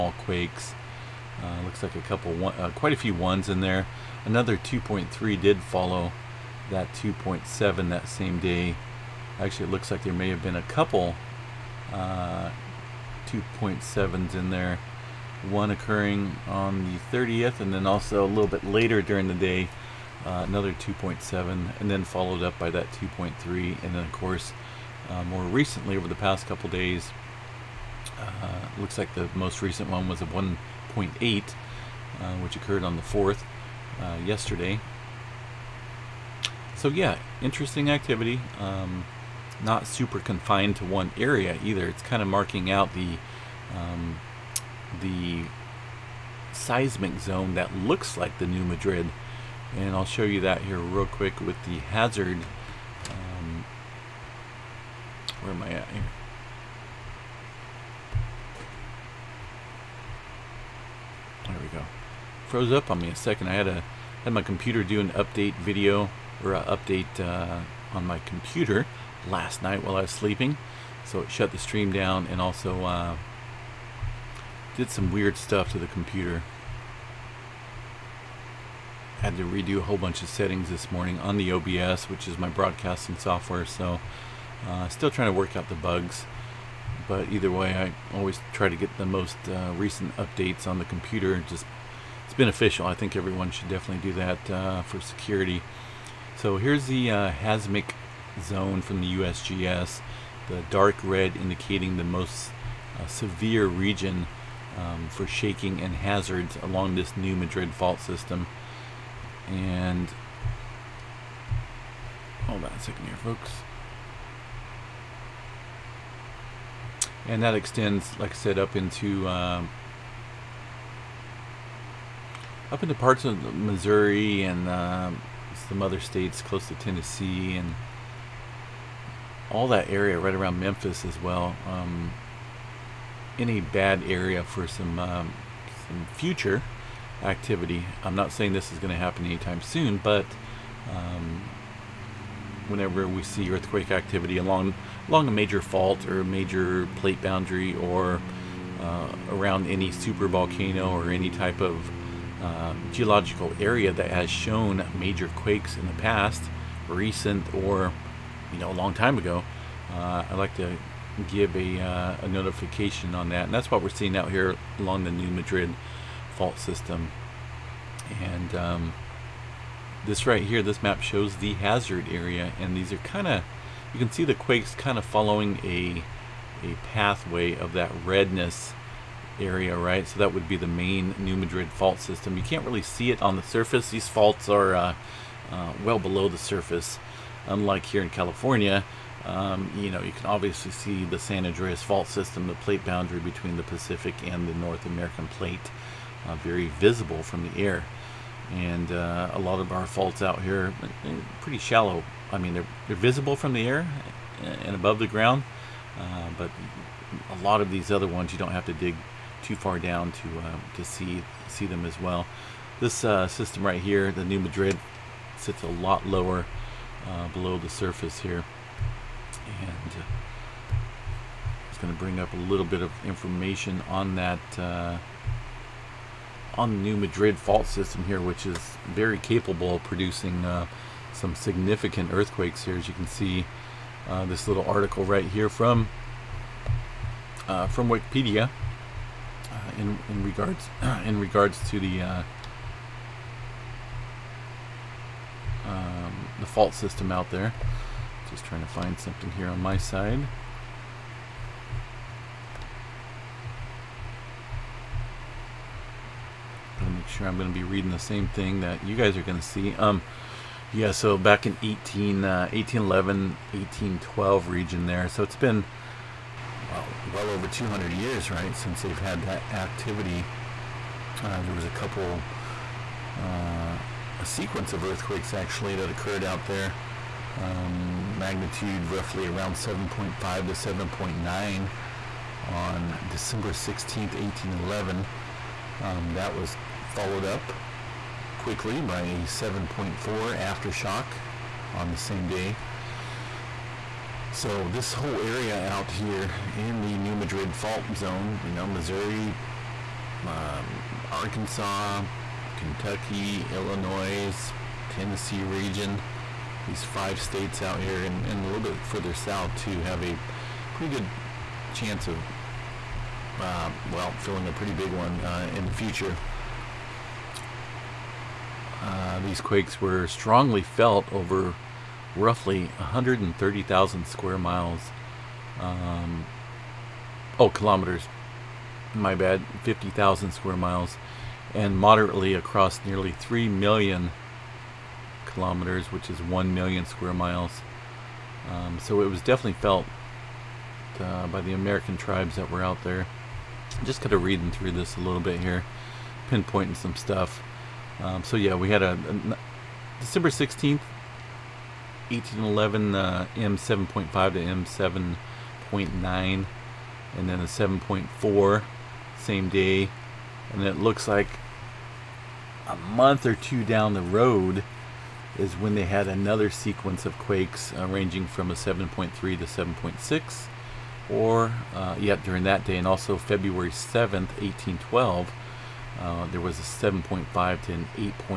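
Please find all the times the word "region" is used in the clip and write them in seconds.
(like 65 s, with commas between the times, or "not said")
103 s, 264 s, 305 s.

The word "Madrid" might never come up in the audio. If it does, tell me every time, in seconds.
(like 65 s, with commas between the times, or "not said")
48 s, 107 s, 165 s, 181 s, 214 s, 226 s, 297 s.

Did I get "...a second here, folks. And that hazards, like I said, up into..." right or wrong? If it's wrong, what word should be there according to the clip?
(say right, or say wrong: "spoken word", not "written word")
wrong: "extends", not "hazards".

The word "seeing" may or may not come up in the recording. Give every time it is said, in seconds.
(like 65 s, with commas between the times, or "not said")
163 s.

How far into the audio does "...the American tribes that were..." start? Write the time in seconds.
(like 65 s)
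341 s.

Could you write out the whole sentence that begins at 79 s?
Had to redo a whole bunch of settings this morning on the OBS, which is my broadcasting software.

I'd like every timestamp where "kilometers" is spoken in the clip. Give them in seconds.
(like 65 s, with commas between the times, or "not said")
327 s, 335 s.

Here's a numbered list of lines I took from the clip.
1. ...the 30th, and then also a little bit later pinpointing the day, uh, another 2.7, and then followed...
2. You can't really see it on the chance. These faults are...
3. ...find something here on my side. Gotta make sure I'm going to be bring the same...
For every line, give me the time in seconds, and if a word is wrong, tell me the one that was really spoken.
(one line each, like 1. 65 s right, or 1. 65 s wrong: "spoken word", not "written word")
1. 16 s wrong: "during", not "pinpointing"
2. 182 s wrong: "surface", not "chance"
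3. 248 s wrong: "reading", not "bring".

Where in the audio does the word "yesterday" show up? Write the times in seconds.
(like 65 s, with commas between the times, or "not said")
34 s.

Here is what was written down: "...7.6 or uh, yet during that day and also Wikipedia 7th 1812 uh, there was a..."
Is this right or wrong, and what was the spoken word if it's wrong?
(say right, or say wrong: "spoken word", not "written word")
wrong: "February", not "Wikipedia".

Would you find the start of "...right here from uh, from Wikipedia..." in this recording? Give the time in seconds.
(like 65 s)
235 s.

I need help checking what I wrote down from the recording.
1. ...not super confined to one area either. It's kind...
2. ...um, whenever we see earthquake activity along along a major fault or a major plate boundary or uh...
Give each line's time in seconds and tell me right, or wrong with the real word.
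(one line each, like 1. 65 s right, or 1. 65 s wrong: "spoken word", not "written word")
1. 39 s right
2. 140 s right.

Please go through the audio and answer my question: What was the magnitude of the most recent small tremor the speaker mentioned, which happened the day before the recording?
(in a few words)
1.8.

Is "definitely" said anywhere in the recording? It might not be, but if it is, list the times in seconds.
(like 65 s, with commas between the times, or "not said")
93 s, 339 s.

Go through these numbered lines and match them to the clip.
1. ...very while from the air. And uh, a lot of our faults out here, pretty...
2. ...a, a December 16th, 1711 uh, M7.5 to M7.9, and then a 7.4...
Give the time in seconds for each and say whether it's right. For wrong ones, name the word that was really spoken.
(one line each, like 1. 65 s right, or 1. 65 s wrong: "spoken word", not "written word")
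1. 196 s wrong: "visible", not "while"
2. 348 s wrong: "1811", not "1711".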